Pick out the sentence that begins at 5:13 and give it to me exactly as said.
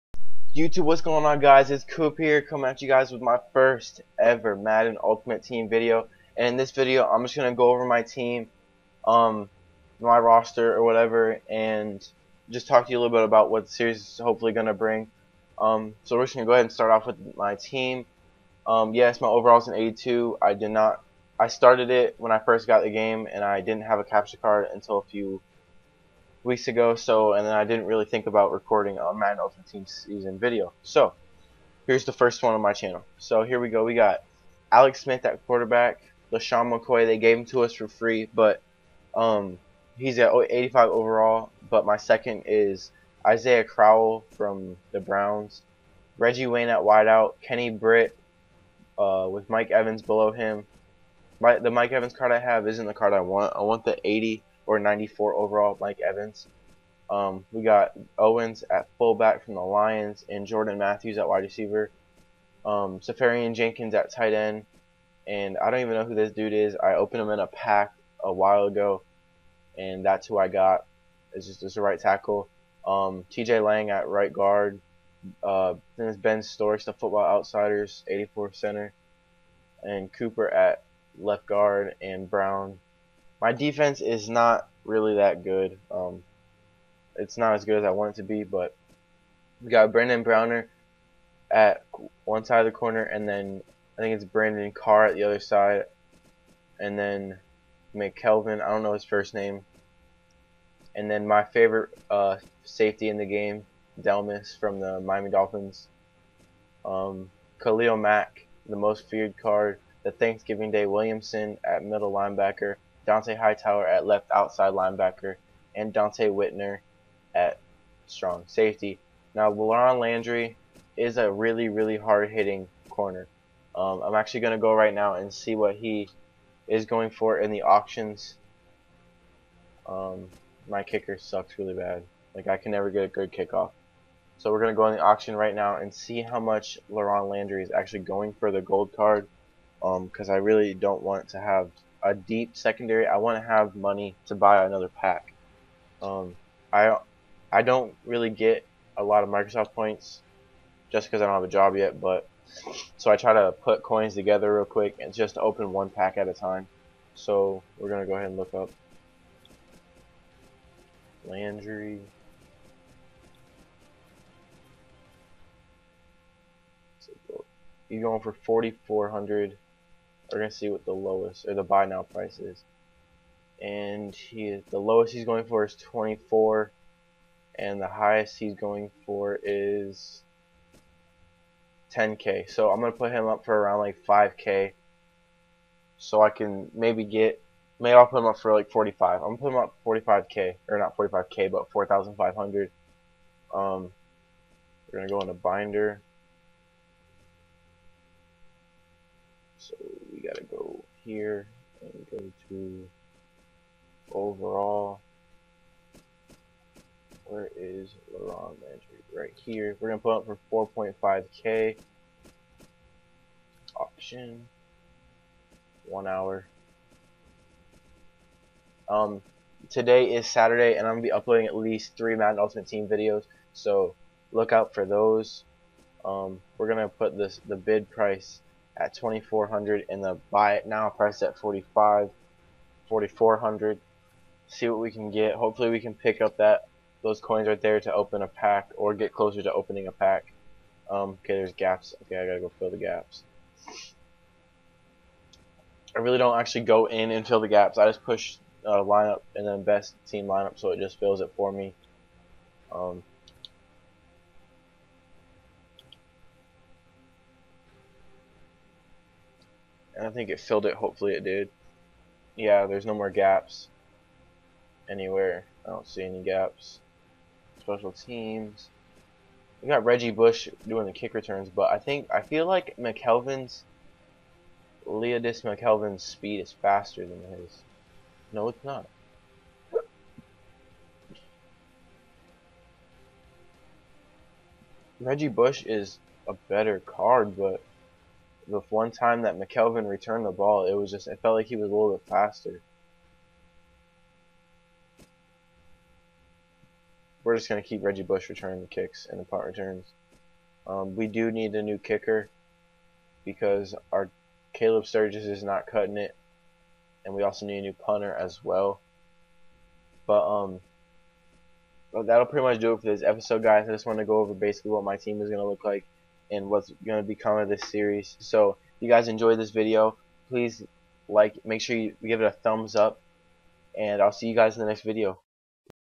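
I just want to go over basically what my team is gonna look like and what's going to become of this series.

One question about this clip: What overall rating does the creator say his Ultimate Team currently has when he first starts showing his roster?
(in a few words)
82.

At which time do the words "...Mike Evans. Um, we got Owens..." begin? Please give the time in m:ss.
0:55.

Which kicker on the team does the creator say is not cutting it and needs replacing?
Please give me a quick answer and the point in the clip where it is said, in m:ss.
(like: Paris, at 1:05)
Caleb Sturgis, at 5:04.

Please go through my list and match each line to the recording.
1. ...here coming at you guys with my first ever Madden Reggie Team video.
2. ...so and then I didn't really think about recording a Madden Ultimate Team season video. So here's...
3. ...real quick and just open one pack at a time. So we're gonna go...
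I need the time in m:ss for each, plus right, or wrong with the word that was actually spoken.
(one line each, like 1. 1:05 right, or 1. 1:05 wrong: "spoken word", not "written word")
1. 0:02 wrong: "Ultimate", not "Reggie"
2. 0:26 right
3. 2:34 right.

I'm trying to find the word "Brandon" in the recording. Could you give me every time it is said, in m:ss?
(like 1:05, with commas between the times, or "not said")
1:29, 1:34.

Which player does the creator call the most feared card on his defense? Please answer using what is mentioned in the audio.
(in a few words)
Khalil Mack.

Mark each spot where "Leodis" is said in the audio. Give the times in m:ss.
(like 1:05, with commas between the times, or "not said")
4:34.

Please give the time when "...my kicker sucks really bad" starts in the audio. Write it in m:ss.
2:10.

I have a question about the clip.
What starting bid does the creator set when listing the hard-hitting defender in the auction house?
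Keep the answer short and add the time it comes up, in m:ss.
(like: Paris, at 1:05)
2400, at 3:48.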